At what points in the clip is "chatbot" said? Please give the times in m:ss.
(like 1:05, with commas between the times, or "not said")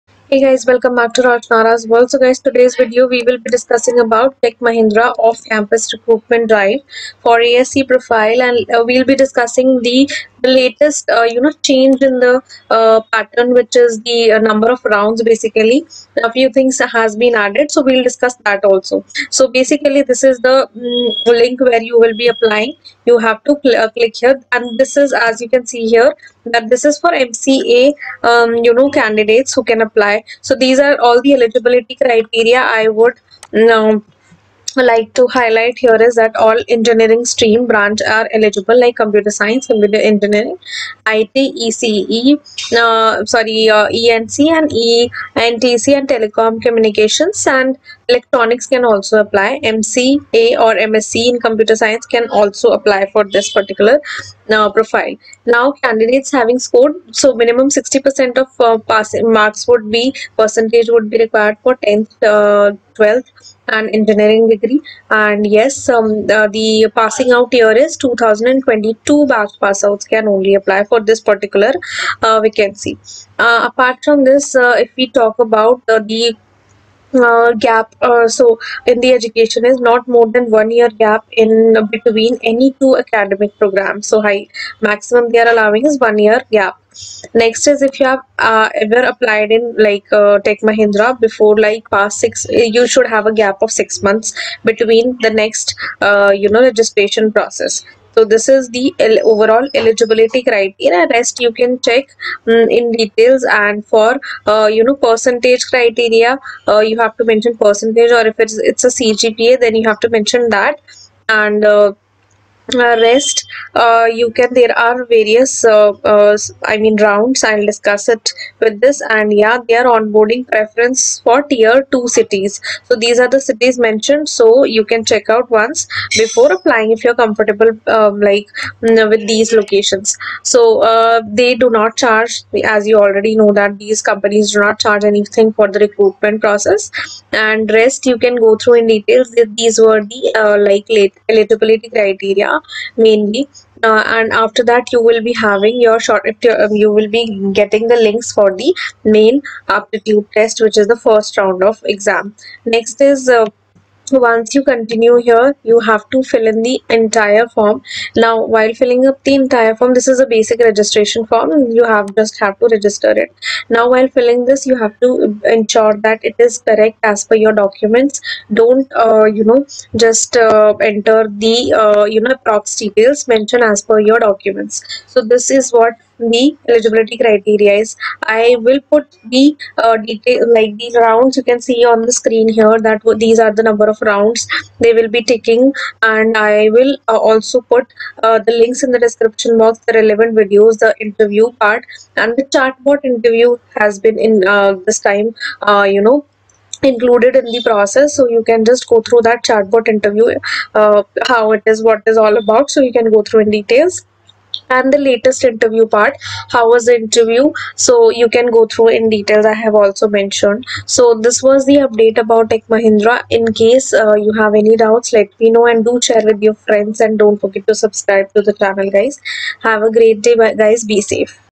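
3:12, 3:19.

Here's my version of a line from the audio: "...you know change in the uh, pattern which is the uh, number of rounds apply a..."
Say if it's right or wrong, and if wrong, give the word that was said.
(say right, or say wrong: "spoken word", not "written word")
wrong: "basically", not "apply".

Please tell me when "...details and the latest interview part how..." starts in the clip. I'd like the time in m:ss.
3:23.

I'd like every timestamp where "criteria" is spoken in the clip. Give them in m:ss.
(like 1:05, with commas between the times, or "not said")
0:32, 1:40, 1:45, 2:21, 2:57.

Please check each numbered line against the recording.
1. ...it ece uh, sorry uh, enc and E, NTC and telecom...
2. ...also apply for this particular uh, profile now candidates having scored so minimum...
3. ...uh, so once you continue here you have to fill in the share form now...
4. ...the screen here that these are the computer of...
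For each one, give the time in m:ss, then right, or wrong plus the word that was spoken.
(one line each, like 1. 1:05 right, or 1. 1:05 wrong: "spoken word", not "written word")
1. 0:41 right
2. 0:52 right
3. 2:33 wrong: "entire", not "share"
4. 3:02 wrong: "number", not "computer".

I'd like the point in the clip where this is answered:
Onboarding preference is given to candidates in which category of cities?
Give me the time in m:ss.
2:01.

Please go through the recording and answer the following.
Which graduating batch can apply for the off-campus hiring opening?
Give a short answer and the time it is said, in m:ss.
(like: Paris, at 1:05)
2022, at 1:08.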